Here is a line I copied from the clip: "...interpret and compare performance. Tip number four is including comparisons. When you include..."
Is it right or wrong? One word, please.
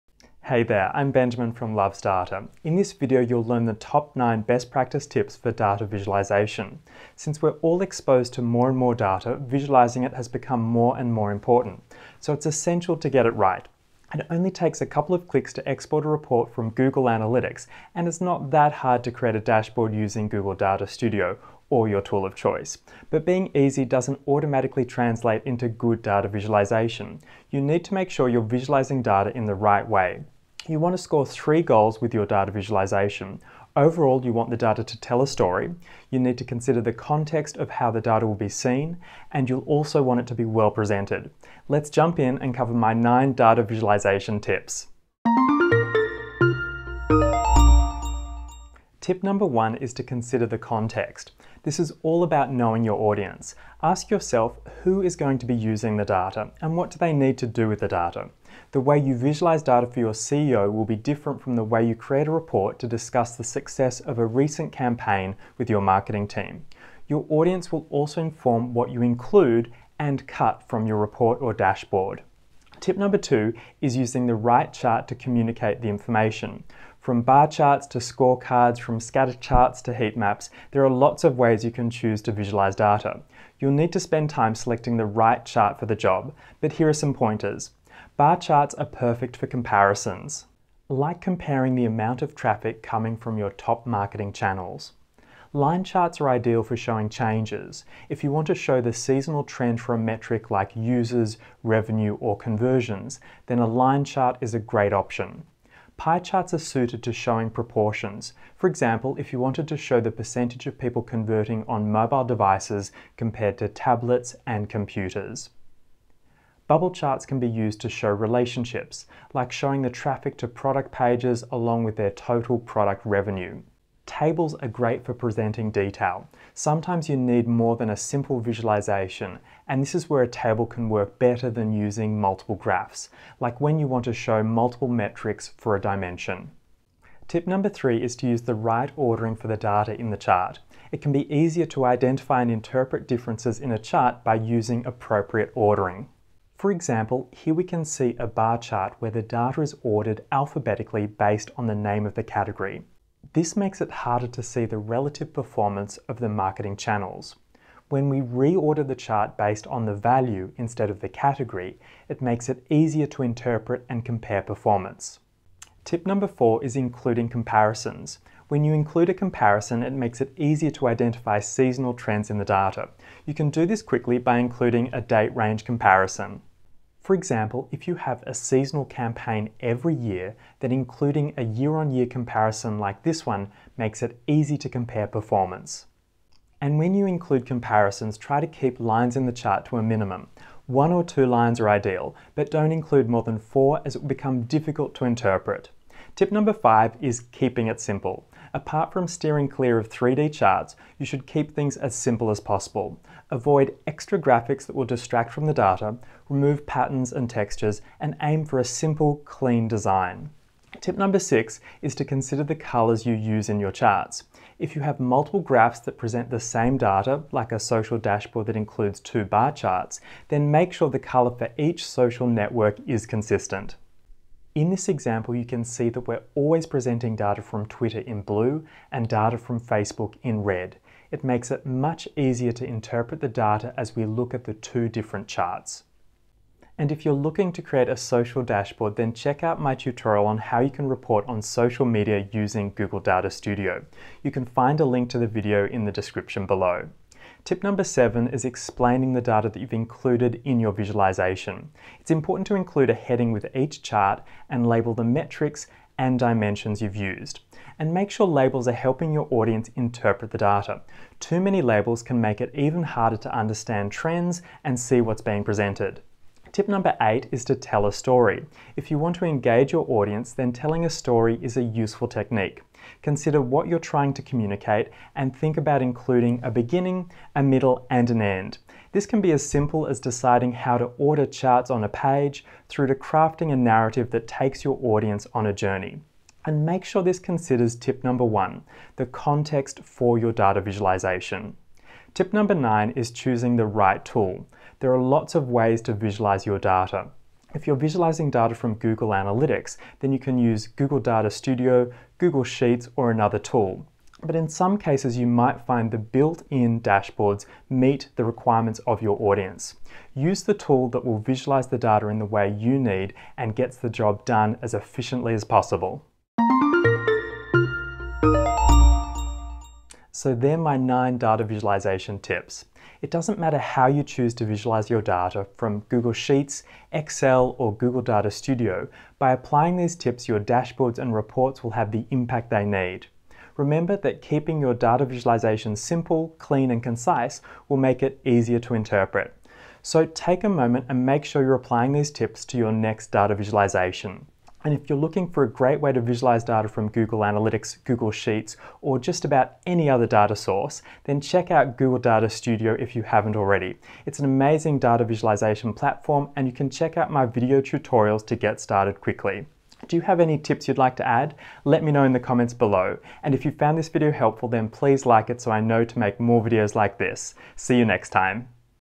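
right.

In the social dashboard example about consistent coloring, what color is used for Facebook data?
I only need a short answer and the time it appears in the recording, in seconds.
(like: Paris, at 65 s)
Red, at 230 s.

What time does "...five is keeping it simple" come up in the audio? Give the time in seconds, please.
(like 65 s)
196 s.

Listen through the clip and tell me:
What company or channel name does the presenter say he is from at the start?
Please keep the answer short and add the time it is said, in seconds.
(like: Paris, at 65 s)
Loves Data, at 1 s.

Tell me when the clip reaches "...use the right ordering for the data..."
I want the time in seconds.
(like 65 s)
138 s.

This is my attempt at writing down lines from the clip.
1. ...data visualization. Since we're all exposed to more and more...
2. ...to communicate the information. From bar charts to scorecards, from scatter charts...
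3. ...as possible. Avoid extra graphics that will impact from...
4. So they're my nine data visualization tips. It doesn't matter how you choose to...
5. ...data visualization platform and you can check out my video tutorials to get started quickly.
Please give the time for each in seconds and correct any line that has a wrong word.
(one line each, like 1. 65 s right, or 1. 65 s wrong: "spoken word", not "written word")
1. 5 s right
2. 75 s right
3. 202 s wrong: "distract", not "impact"
4. 320 s right
5. 354 s right.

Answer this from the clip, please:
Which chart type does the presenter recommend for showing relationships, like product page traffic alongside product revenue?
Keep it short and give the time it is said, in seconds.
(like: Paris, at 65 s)
Bubble charts, at 116 s.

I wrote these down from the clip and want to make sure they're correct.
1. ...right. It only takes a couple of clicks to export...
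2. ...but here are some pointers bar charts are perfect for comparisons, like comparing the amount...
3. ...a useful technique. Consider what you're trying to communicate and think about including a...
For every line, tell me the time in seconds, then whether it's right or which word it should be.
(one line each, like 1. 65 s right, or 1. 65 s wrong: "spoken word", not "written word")
1. 13 s right
2. 86 s right
3. 271 s right.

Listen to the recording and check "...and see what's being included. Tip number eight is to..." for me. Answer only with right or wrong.
wrong.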